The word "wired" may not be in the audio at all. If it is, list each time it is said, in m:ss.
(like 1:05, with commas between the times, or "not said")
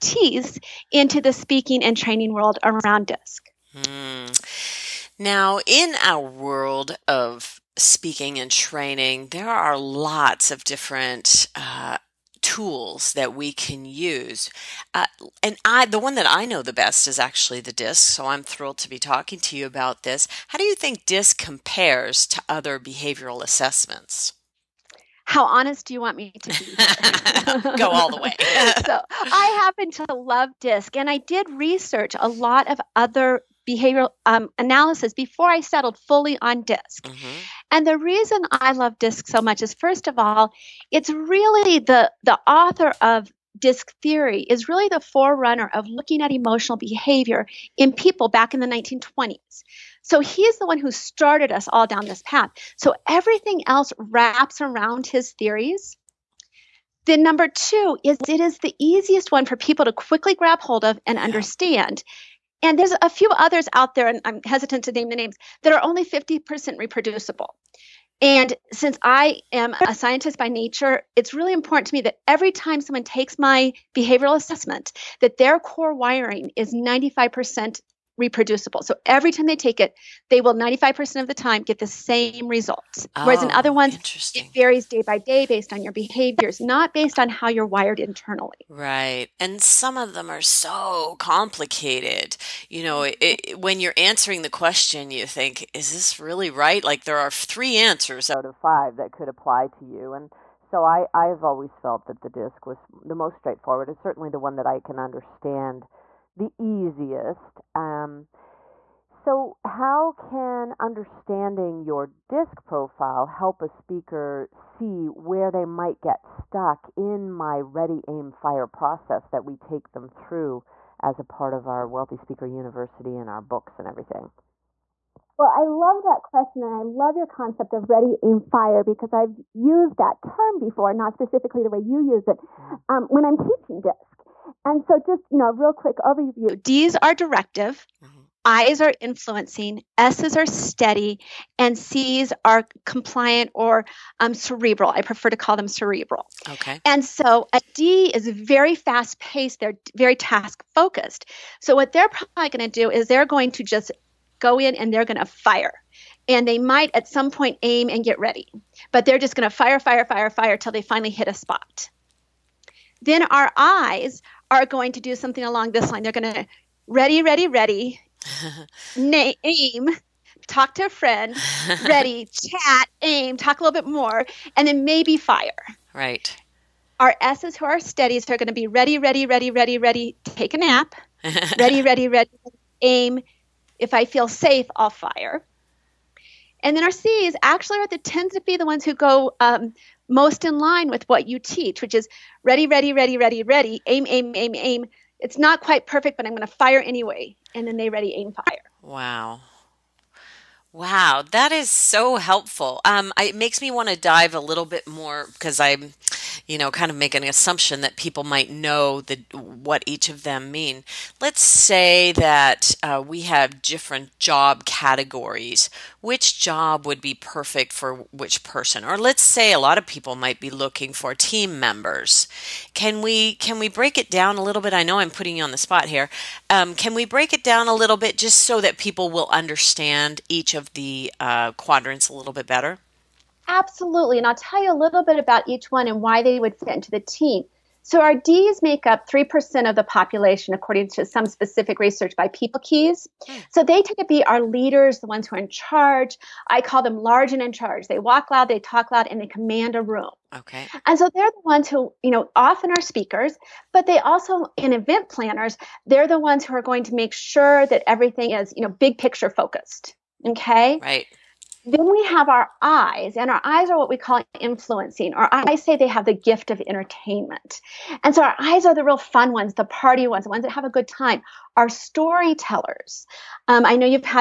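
1:27.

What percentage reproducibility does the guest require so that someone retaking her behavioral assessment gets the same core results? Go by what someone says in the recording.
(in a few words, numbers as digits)
95%.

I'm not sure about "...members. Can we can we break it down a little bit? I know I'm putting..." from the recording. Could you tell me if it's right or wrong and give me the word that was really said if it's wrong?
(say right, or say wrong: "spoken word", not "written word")
right.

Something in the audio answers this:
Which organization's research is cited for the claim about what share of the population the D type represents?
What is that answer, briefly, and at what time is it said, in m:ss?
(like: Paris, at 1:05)
PeopleKeys, at 4:02.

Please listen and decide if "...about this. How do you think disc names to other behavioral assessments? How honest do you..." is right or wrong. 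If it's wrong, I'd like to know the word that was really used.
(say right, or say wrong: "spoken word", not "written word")
wrong: "compares", not "names".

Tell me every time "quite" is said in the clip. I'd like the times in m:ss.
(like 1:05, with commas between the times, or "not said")
3:15.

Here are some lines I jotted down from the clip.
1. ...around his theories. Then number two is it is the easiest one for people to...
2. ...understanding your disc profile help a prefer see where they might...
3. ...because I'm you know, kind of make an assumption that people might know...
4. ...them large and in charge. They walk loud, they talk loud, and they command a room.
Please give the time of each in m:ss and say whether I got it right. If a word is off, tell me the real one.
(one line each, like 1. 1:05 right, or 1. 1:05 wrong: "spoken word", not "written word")
1. 0:54 right
2. 1:50 wrong: "speaker", not "prefer"
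3. 3:25 right
4. 4:06 right.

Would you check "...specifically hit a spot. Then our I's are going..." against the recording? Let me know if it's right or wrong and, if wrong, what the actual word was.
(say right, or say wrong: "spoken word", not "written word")
wrong: "finally", not "specifically".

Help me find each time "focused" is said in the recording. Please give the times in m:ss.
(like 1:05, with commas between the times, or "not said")
2:30, 4:19.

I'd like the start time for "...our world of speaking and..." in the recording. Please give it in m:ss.
0:06.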